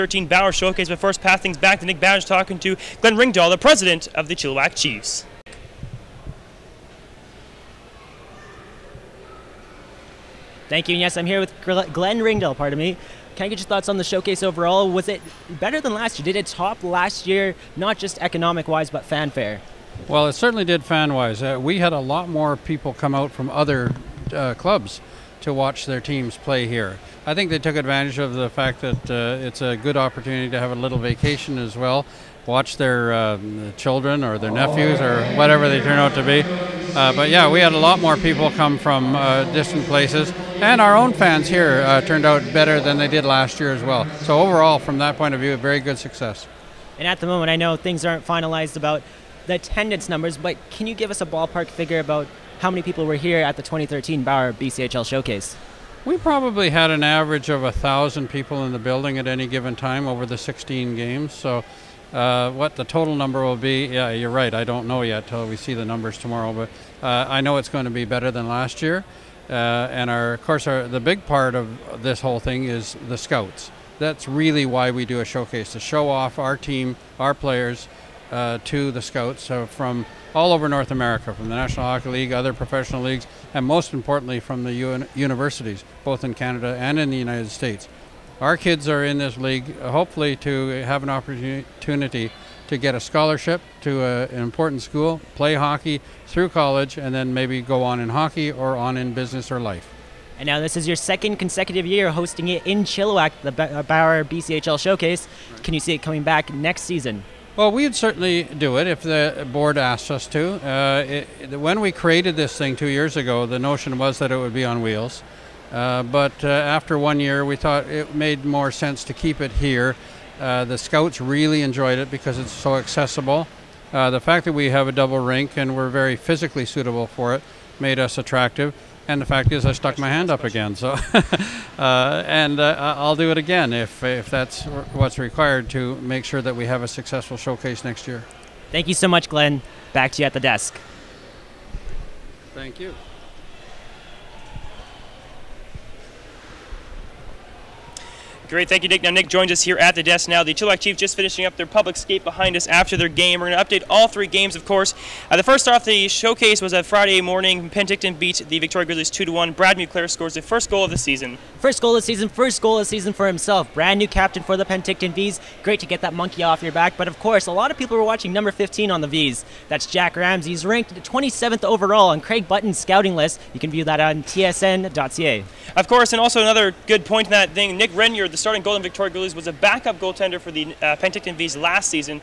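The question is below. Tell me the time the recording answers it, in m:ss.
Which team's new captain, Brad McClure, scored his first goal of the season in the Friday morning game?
2:44.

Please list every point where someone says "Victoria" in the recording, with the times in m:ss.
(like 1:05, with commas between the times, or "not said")
2:38, 2:58.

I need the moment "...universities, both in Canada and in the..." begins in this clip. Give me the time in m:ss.
1:25.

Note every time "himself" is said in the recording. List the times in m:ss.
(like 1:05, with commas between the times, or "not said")
2:43.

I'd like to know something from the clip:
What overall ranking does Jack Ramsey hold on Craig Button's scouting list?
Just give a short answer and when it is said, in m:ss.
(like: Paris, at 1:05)
27th, at 2:50.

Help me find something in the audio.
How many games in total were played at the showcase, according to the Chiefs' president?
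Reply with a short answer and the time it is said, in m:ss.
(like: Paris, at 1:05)
16, at 1:00.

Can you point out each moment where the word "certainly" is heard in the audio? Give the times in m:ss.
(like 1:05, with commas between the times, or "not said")
0:20, 1:47.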